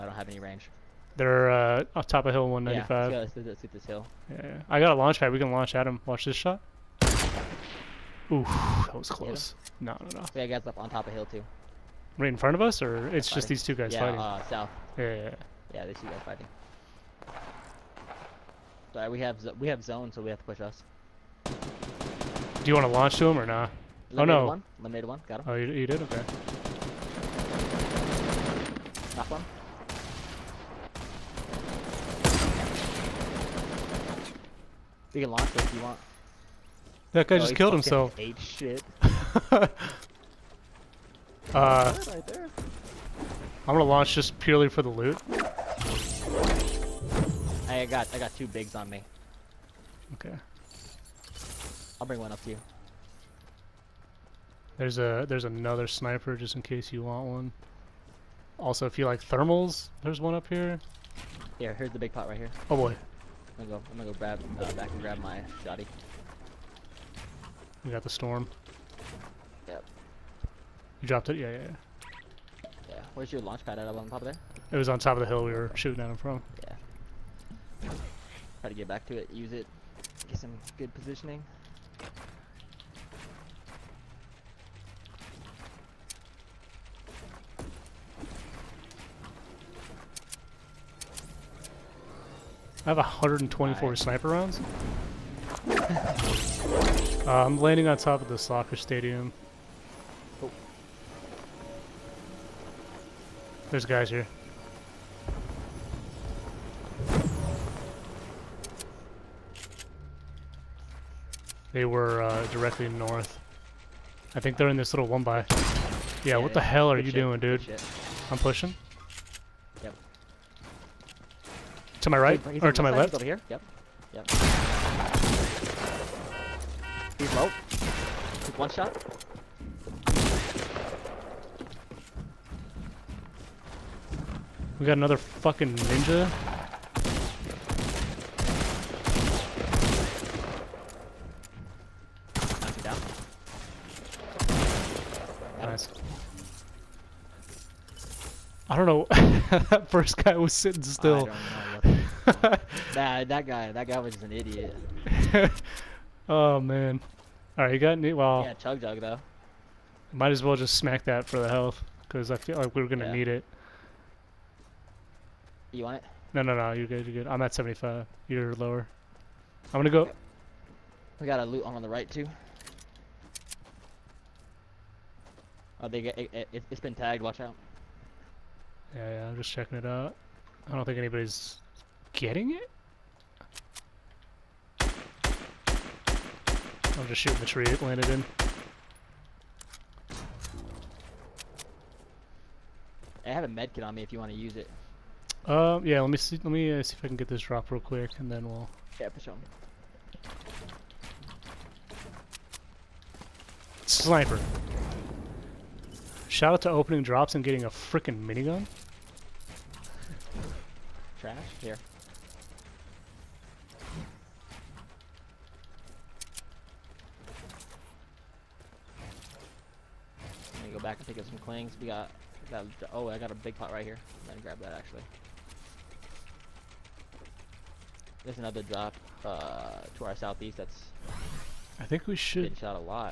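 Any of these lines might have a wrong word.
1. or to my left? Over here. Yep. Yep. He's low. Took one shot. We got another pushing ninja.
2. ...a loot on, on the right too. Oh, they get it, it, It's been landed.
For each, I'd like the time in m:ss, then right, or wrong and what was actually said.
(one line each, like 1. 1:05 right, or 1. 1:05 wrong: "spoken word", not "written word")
1. 2:02 wrong: "fucking", not "pushing"
2. 2:51 wrong: "tagged", not "landed".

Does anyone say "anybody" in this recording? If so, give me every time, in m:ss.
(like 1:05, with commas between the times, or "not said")
3:00.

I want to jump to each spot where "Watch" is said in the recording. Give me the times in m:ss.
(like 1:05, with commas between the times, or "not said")
0:06, 2:57.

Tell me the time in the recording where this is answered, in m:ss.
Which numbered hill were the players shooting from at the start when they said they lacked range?
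0:02.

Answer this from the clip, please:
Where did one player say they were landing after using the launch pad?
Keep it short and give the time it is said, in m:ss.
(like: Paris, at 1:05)
Soccer stadium, at 1:38.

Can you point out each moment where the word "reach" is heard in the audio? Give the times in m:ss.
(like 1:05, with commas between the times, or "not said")
not said.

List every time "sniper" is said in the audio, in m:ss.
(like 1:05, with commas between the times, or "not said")
0:55, 1:33, 3:23.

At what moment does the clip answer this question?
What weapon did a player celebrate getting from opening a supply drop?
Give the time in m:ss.
3:28.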